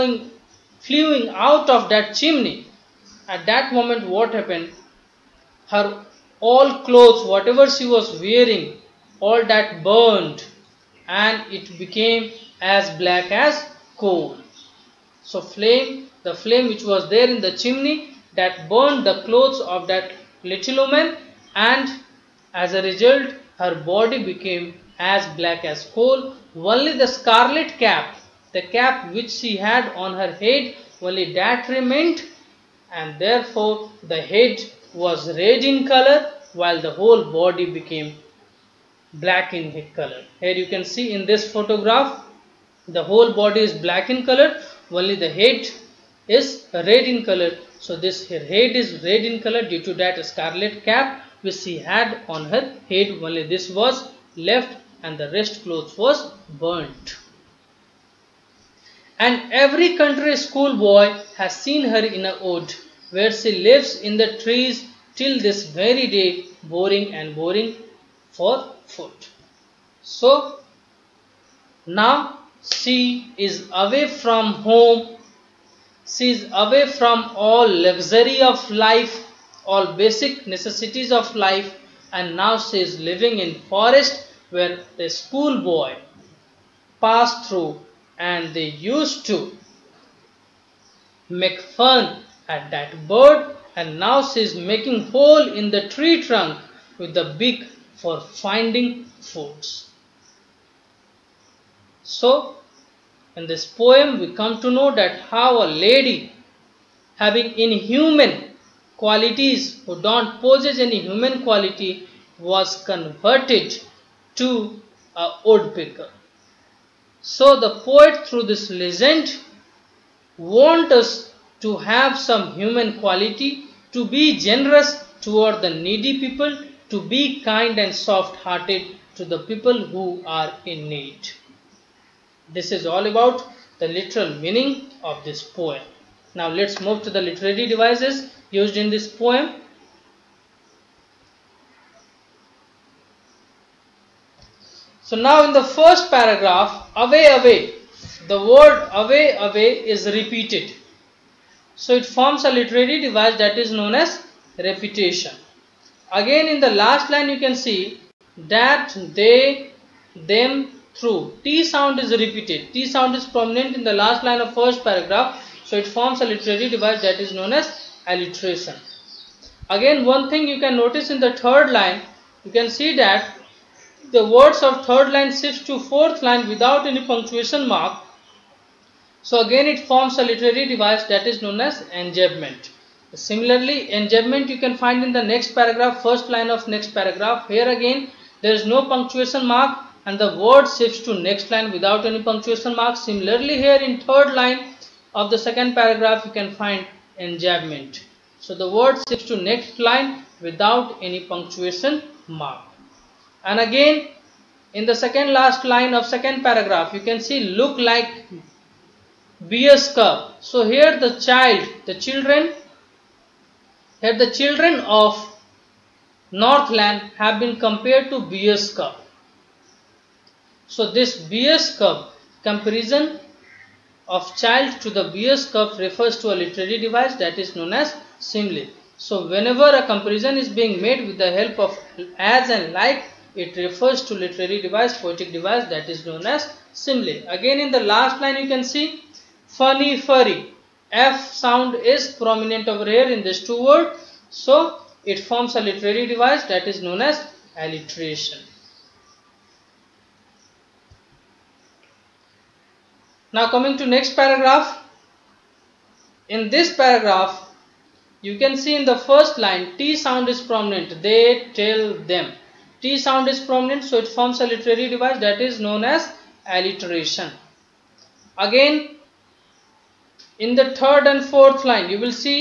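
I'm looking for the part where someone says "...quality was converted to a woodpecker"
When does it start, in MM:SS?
01:51.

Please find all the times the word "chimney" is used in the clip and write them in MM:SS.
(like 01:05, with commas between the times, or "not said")
00:02, 00:17.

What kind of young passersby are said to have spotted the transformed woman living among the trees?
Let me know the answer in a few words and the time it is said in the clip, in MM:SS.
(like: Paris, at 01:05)
country schoolboy, at 00:59.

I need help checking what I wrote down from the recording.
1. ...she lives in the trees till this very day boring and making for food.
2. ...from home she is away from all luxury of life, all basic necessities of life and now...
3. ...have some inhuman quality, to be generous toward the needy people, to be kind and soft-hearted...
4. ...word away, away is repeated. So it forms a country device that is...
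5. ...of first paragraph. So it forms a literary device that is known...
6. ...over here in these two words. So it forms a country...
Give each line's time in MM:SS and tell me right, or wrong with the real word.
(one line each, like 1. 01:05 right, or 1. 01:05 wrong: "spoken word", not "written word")
1. 01:03 wrong: "boring", not "making"
2. 01:14 right
3. 02:01 wrong: "human", not "inhuman"
4. 02:28 wrong: "literary", not "country"
5. 02:44 right
6. 04:02 wrong: "literary", not "country".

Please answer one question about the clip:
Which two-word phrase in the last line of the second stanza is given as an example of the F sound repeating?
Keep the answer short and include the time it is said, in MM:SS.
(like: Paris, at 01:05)
funny furry, at 03:59.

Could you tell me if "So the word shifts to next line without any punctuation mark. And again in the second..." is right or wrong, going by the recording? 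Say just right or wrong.
right.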